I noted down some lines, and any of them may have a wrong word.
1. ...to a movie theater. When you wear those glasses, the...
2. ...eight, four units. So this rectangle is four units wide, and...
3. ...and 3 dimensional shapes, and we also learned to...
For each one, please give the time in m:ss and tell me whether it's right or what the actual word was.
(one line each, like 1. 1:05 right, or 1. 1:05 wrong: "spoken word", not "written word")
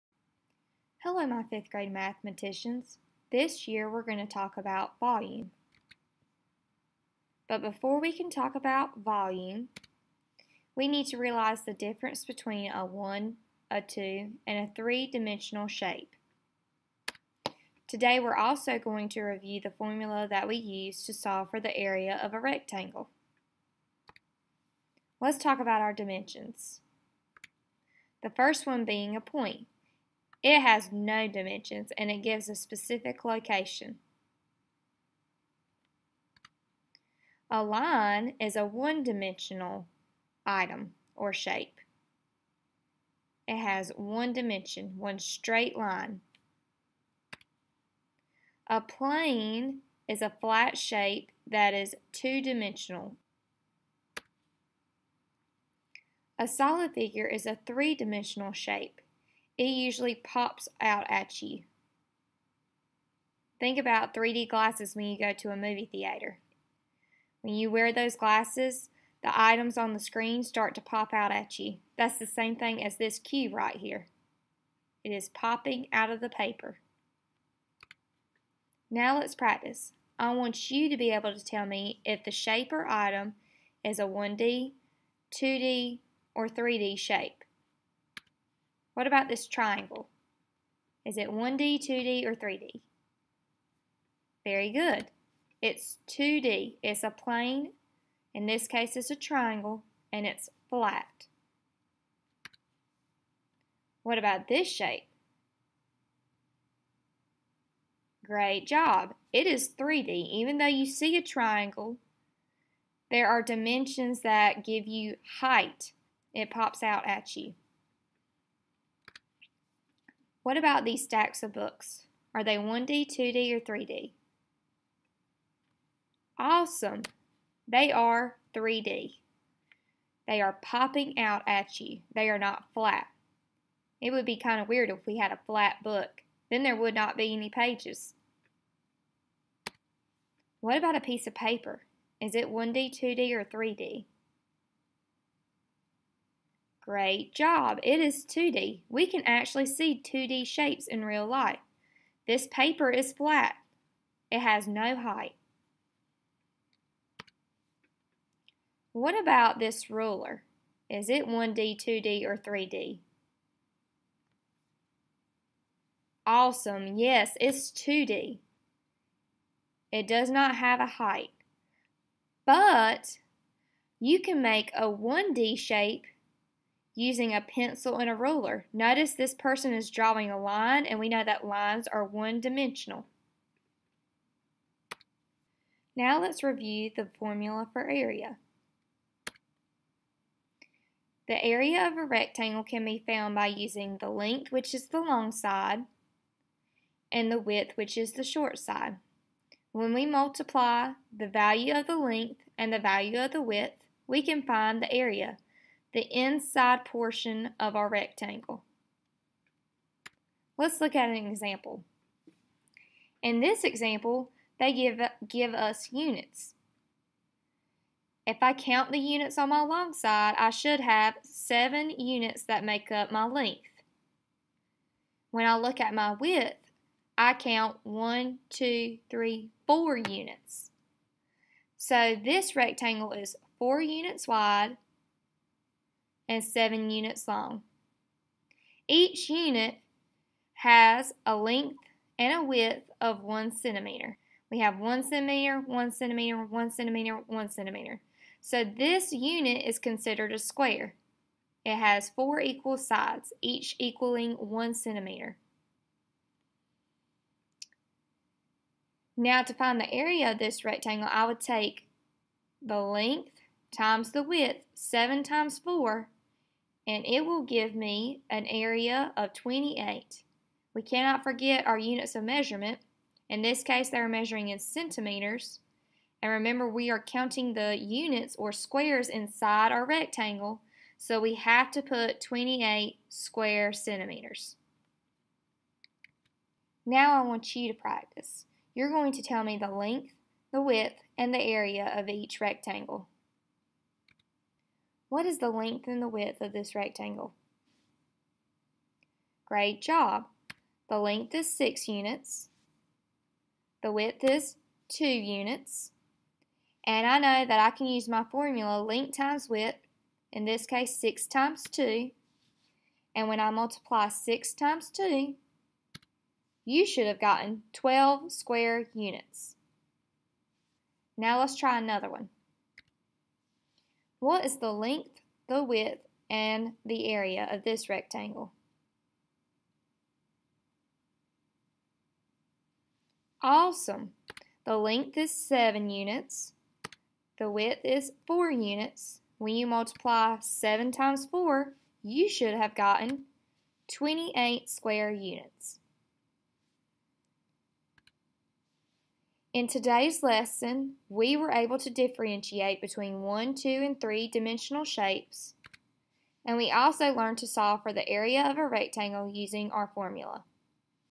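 1. 1:05 right
2. 3:49 wrong: "three", not "eight"
3. 5:53 right.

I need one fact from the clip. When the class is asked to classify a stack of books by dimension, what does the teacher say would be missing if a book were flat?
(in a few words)
pages.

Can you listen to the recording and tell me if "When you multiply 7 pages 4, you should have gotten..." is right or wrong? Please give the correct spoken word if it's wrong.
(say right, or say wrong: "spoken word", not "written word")
wrong: "times", not "pages".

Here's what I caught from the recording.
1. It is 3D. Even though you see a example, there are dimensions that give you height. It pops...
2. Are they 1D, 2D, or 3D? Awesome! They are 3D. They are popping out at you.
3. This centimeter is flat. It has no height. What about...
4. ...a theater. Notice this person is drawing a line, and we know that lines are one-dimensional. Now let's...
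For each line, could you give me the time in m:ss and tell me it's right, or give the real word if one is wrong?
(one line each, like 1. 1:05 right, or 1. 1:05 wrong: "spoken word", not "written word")
1. 1:49 wrong: "triangle", not "example"
2. 2:02 right
3. 2:32 wrong: "paper", not "centimeter"
4. 2:58 wrong: "ruler", not "theater".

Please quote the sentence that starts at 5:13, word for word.
And when I multiply 6 times 2, you should have gotten 12 square units.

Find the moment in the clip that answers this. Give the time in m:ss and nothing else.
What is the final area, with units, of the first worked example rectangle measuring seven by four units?
4:42.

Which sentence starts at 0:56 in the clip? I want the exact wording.
A solid figure is a three-dimensional shape it usually pops out at you.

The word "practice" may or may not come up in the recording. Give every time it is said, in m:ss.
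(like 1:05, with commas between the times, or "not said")
1:19, 4:47.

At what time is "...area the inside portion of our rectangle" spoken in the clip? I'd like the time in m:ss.
3:24.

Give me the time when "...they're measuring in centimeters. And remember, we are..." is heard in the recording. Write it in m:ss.
4:33.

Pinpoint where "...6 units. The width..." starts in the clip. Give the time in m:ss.
5:01.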